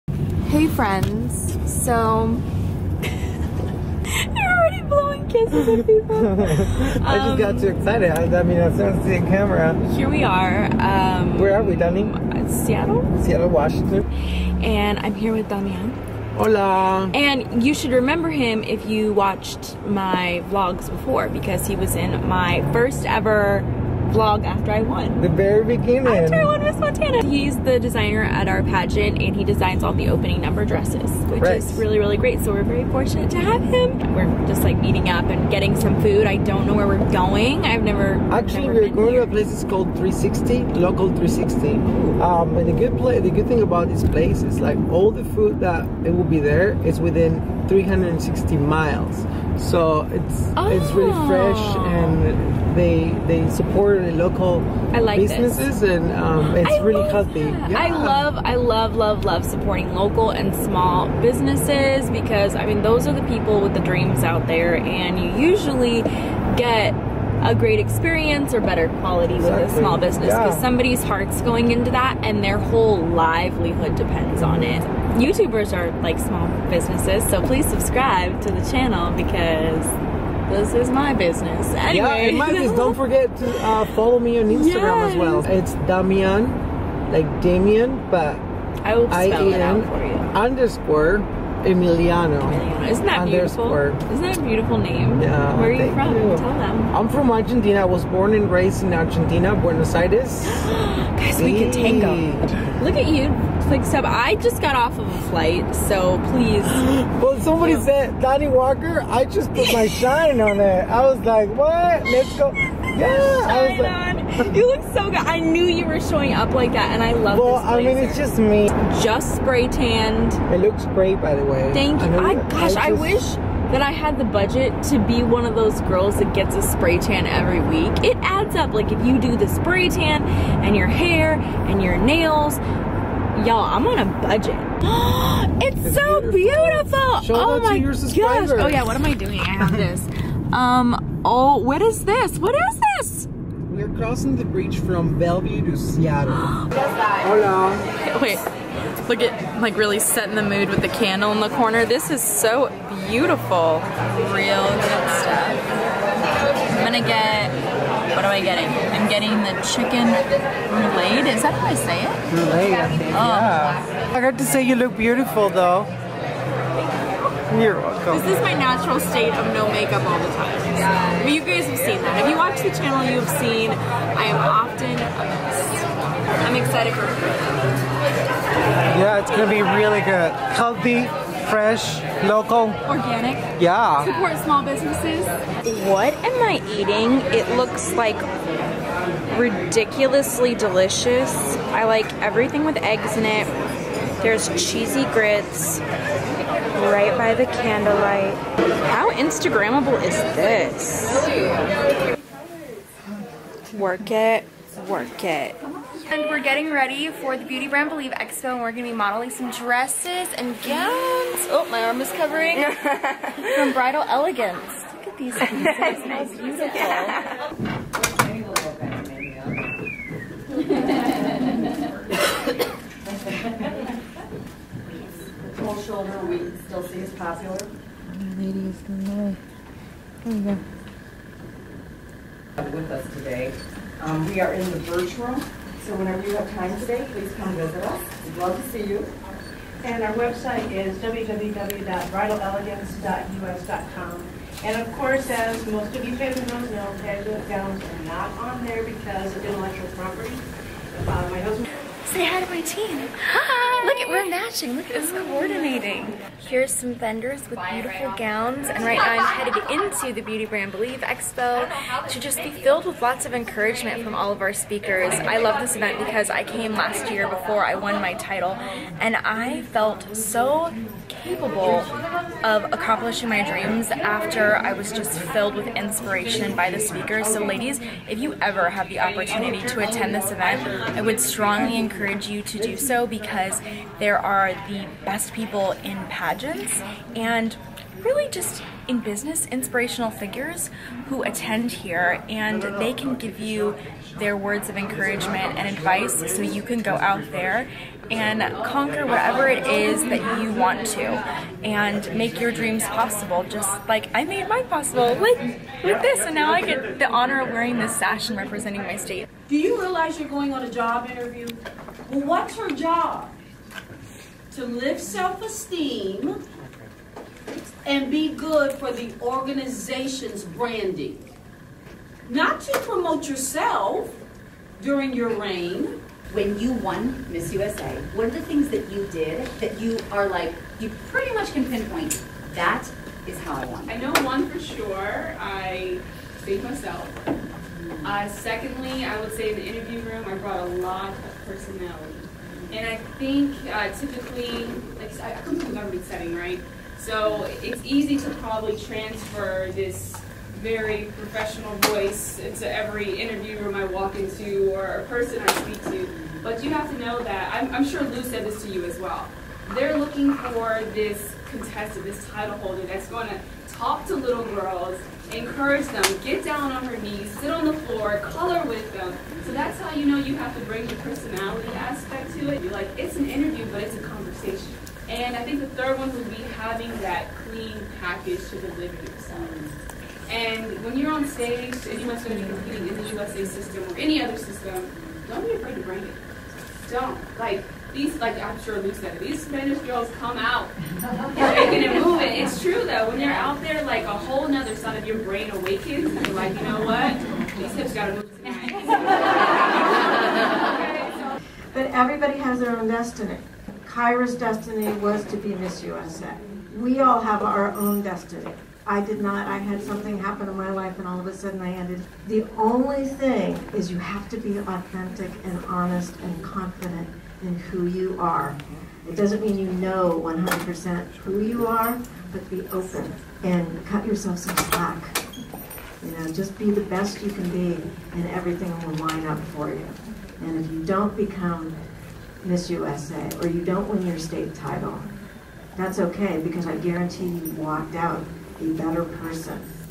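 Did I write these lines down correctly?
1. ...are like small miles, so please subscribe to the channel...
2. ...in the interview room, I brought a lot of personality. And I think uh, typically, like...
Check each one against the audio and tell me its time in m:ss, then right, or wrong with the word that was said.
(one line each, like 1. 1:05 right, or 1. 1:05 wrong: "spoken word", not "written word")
1. 1:15 wrong: "businesses", not "miles"
2. 5:39 right.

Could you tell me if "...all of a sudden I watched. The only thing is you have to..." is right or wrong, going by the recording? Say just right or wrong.
wrong.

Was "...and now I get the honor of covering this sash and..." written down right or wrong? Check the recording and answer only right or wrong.
wrong.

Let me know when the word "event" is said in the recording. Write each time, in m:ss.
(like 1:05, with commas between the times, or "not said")
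4:25, 4:40.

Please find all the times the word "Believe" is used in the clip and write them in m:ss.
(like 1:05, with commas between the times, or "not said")
3:27, 4:20.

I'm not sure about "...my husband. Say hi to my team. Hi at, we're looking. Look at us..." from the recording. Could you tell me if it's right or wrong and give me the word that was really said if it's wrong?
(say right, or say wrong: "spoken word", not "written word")
wrong: "matching", not "looking".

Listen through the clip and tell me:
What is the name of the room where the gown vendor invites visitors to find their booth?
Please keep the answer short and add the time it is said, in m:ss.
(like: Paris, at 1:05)
Birch Room, at 3:54.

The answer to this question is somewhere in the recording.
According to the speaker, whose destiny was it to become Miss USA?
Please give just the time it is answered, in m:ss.
6:43.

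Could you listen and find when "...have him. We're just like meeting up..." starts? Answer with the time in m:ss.
0:33.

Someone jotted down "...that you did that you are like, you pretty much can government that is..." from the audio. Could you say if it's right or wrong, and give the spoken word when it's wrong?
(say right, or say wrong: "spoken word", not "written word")
wrong: "pinpoint", not "government".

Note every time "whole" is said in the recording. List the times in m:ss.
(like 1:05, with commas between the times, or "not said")
1:12, 6:34.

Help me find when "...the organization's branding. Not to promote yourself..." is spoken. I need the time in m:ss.
5:18.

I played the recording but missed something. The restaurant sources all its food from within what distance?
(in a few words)
360 miles.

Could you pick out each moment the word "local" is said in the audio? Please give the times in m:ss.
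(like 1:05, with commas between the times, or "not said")
0:40, 0:54, 0:59, 3:02.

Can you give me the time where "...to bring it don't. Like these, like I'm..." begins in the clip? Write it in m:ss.
6:25.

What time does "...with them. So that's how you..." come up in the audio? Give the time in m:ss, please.
6:08.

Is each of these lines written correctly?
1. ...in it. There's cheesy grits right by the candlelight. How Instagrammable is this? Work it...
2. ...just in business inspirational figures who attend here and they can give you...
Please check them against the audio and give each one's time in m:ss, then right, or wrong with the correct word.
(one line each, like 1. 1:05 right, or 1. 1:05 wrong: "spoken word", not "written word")
1. 3:13 right
2. 4:48 right.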